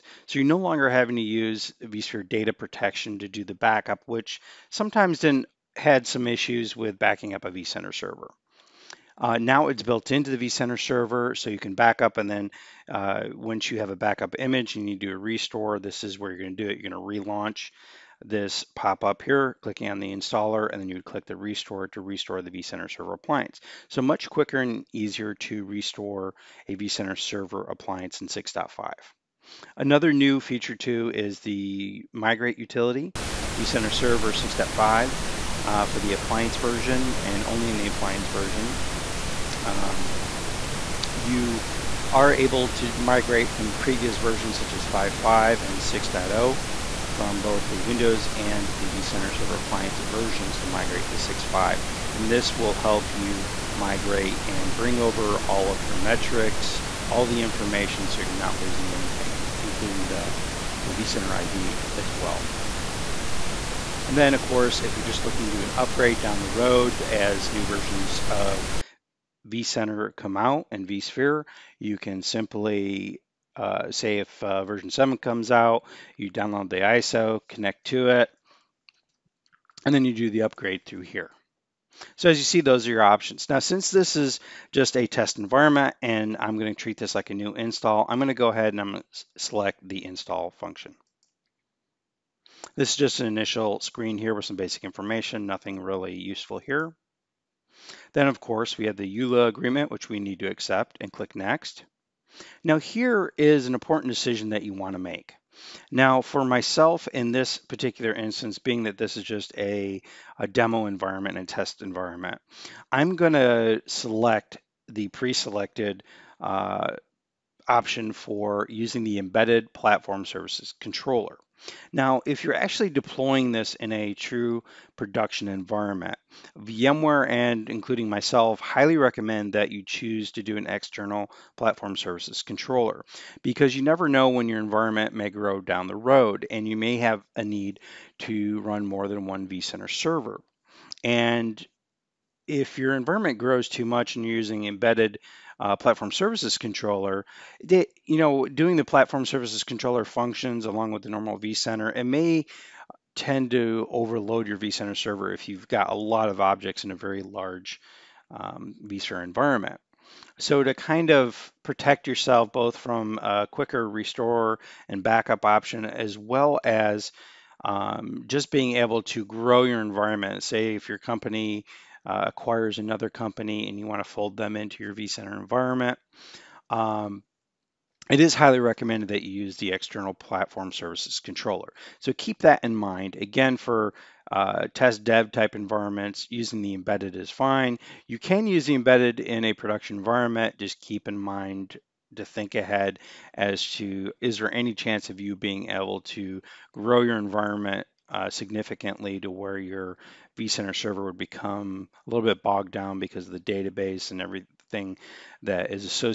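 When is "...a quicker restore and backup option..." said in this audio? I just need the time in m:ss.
2:43.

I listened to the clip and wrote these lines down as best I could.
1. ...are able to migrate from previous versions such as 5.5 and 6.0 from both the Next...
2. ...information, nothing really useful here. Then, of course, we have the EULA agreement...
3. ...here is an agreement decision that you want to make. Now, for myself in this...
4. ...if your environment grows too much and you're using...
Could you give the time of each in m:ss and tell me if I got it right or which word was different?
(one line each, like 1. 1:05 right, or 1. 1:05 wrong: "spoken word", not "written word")
1. 0:42 wrong: "Windows", not "Next"
2. 1:34 right
3. 1:42 wrong: "important", not "agreement"
4. 2:22 right.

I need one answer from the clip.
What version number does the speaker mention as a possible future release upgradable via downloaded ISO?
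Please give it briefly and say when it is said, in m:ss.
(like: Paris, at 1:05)
7, at 1:14.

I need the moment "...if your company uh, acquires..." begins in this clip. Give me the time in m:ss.
2:50.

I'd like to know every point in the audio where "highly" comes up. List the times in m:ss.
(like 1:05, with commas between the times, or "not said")
2:08, 2:58.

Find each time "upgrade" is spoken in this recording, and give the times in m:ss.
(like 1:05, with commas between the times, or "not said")
1:05, 1:20.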